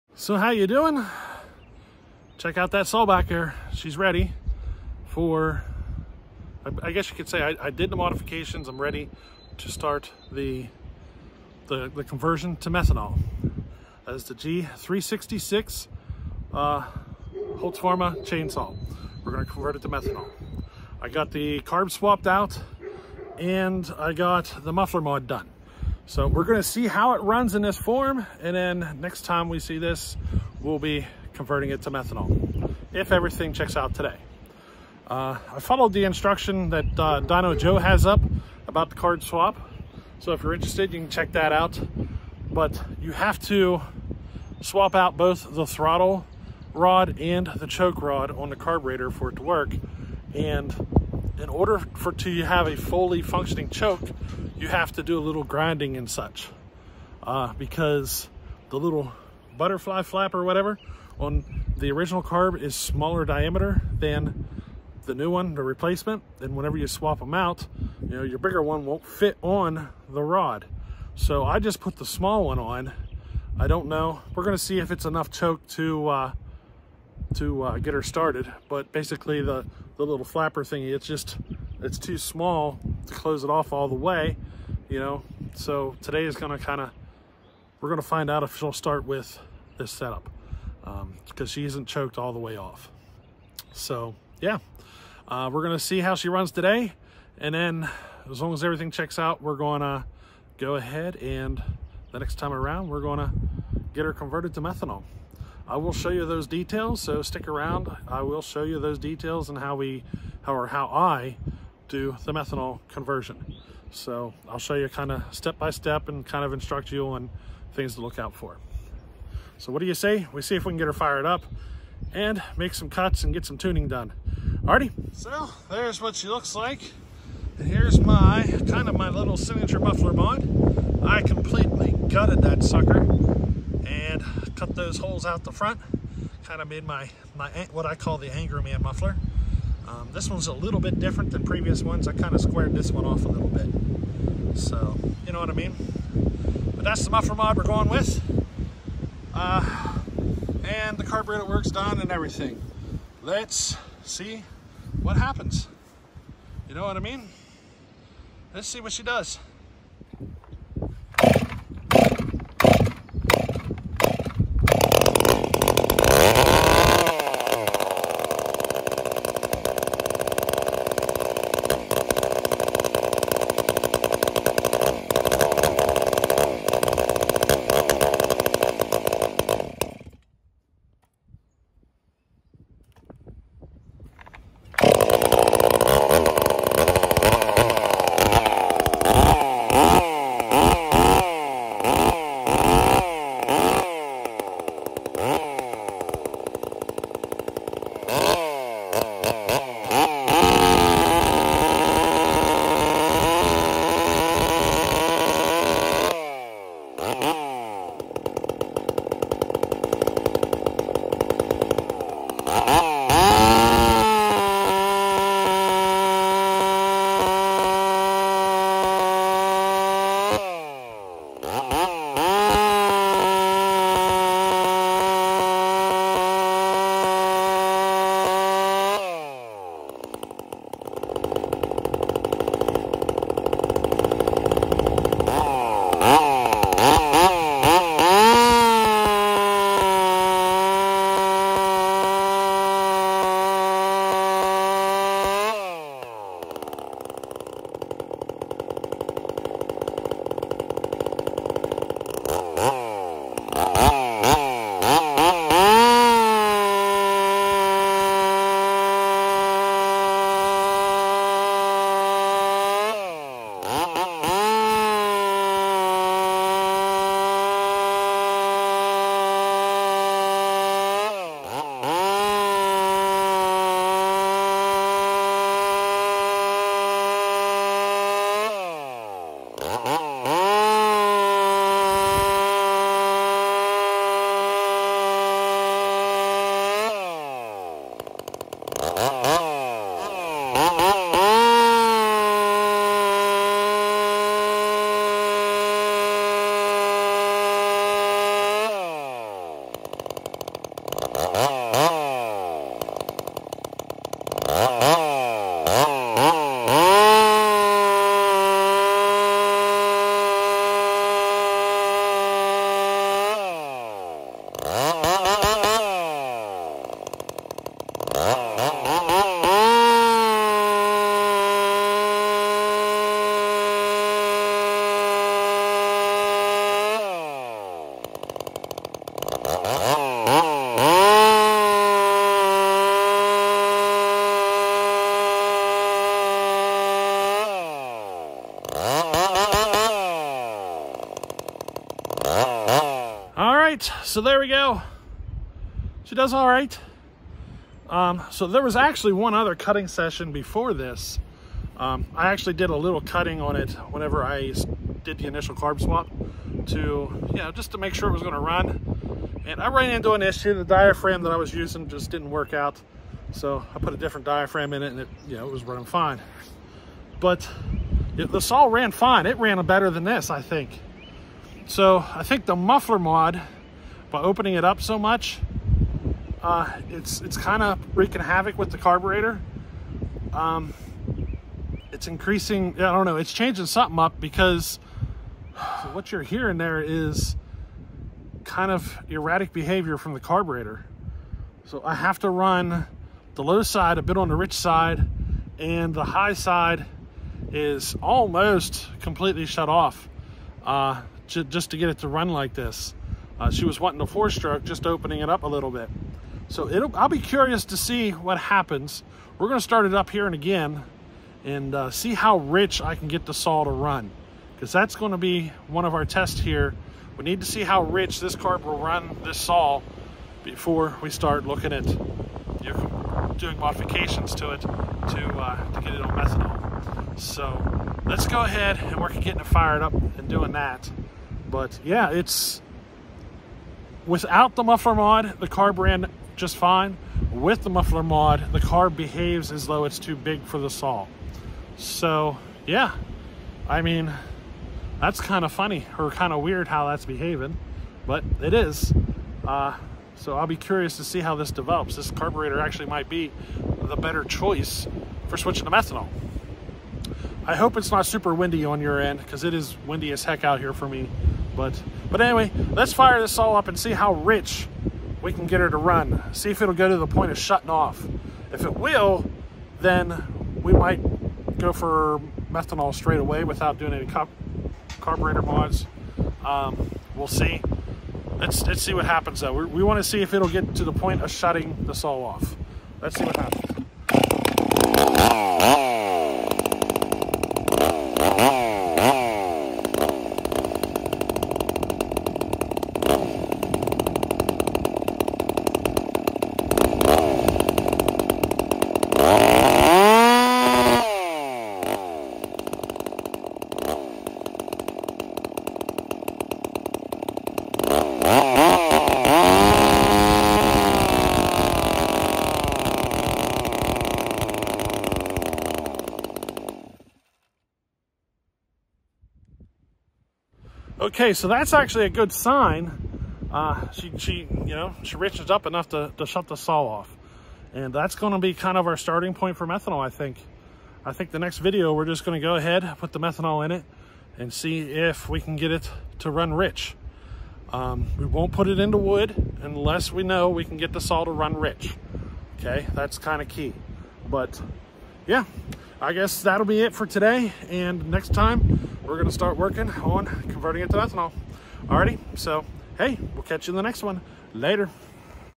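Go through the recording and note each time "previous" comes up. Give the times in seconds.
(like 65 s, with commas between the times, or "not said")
141 s.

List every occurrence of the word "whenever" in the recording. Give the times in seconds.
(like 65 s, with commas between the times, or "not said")
66 s, 353 s.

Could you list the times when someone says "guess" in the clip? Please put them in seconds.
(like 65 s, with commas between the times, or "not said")
6 s, 546 s.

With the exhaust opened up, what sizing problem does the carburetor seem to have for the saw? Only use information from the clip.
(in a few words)
too big.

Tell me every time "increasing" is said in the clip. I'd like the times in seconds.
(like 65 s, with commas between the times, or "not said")
382 s.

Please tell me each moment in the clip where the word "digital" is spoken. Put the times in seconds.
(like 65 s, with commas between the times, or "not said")
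not said.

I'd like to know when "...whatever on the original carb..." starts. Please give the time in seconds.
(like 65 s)
60 s.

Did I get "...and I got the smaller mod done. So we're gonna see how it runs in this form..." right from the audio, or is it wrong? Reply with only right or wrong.
wrong.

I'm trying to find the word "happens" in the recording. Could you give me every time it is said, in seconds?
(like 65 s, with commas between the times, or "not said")
155 s, 408 s, 479 s, 483 s.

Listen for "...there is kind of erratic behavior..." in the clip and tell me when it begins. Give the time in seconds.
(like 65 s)
386 s.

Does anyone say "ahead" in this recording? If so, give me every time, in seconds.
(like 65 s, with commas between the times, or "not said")
100 s, 428 s, 532 s.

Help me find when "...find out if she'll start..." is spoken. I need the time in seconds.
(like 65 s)
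88 s.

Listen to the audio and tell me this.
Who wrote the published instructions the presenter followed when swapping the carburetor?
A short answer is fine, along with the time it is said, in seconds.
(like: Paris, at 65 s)
Dino Joe, at 37 s.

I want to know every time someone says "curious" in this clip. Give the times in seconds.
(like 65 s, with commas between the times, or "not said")
407 s, 450 s.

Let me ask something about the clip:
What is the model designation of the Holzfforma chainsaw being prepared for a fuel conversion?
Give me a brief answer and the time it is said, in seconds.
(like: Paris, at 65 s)
G366, at 14 s.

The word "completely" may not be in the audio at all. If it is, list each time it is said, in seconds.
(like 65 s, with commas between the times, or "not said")
131 s, 399 s.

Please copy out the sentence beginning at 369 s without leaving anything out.
It ran better than this, I think.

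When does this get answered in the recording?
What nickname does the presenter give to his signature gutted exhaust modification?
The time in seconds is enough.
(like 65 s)
138 s.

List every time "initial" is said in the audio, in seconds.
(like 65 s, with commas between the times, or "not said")
355 s.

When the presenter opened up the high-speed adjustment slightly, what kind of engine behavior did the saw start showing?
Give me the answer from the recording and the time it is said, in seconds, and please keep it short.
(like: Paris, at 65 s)
four stroke, at 404 s.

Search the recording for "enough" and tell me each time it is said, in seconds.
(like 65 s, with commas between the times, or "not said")
75 s, 525 s.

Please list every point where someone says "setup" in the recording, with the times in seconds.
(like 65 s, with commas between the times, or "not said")
89 s.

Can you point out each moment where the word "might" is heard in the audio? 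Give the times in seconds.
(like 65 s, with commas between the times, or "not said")
452 s, 470 s.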